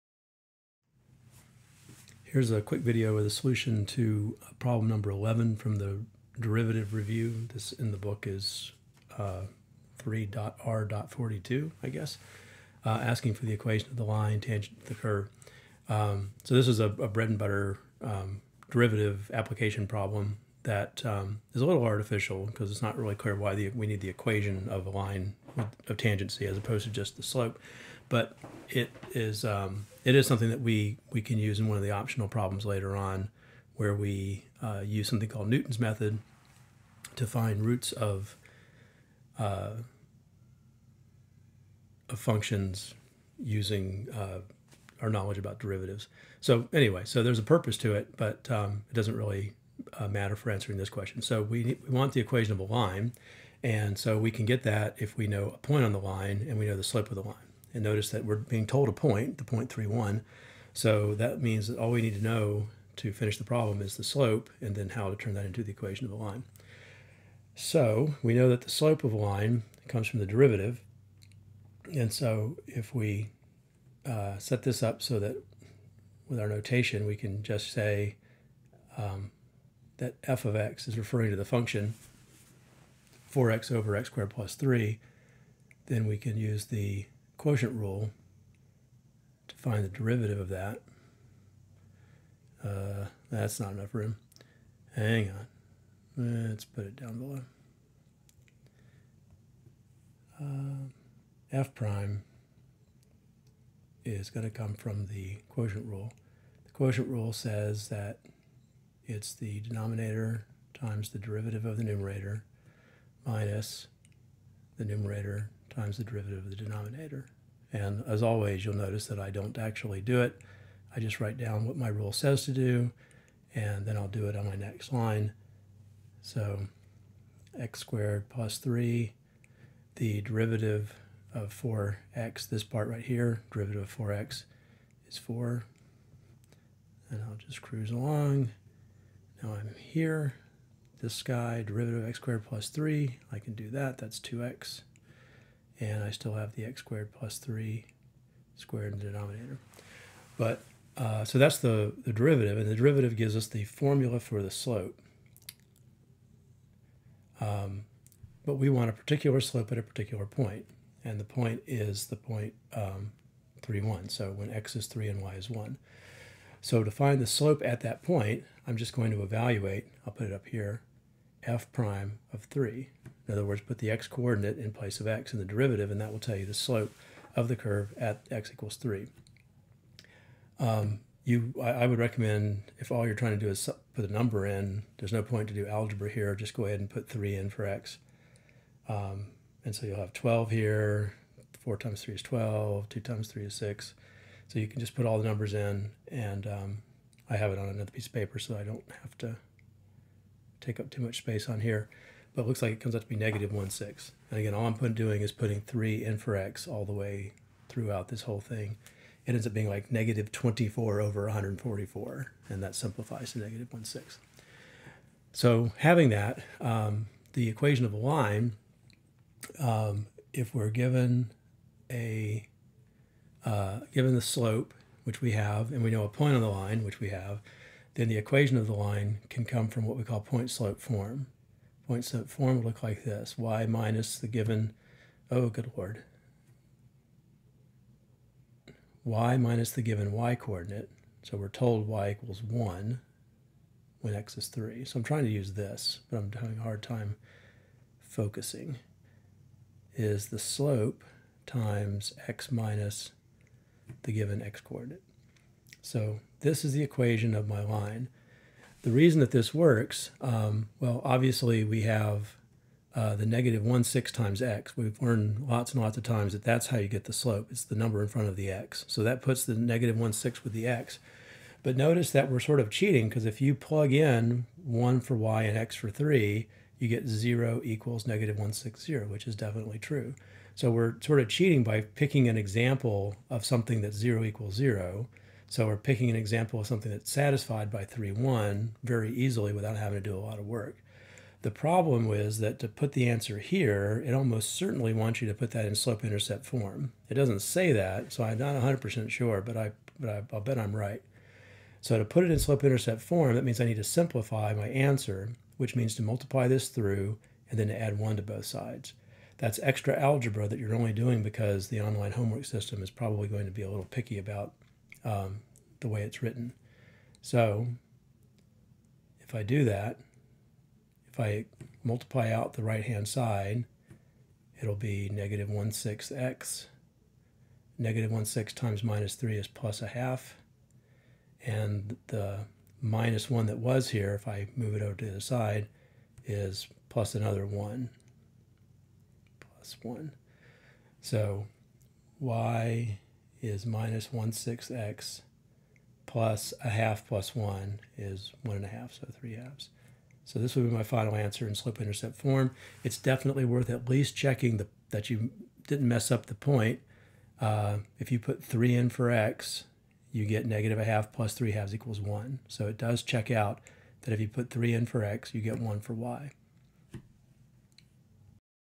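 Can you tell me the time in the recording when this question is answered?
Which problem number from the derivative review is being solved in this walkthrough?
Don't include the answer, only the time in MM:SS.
00:04.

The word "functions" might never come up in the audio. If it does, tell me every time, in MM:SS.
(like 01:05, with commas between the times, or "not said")
00:42, 01:21.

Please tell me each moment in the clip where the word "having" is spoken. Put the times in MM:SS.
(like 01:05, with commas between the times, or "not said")
03:35, 04:06, 04:49.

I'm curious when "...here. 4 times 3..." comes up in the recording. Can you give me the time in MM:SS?
03:10.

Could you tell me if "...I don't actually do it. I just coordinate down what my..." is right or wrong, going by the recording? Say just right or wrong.
wrong.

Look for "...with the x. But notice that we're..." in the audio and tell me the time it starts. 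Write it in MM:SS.
04:30.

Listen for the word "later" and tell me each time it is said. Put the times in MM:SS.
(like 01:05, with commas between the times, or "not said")
00:32.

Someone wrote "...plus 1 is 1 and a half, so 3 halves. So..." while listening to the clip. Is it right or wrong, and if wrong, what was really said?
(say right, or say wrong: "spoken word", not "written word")
right.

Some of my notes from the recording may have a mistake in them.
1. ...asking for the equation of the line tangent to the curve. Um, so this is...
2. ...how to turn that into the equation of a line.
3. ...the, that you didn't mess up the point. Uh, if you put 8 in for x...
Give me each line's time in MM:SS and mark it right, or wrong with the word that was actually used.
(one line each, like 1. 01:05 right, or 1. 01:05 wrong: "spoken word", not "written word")
1. 00:13 right
2. 01:04 right
3. 05:54 wrong: "3", not "8".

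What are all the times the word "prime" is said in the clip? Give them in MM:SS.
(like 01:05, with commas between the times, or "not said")
01:41, 02:51.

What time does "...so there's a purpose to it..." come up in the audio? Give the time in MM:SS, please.
00:47.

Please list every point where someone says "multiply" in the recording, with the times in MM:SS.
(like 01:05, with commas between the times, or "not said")
05:06, 05:21.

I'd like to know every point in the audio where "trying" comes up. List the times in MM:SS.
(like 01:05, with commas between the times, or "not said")
03:03, 04:05.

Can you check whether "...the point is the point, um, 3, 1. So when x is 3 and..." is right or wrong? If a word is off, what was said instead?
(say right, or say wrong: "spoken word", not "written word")
right.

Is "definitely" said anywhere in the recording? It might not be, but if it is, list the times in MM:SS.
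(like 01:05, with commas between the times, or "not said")
04:39, 05:52.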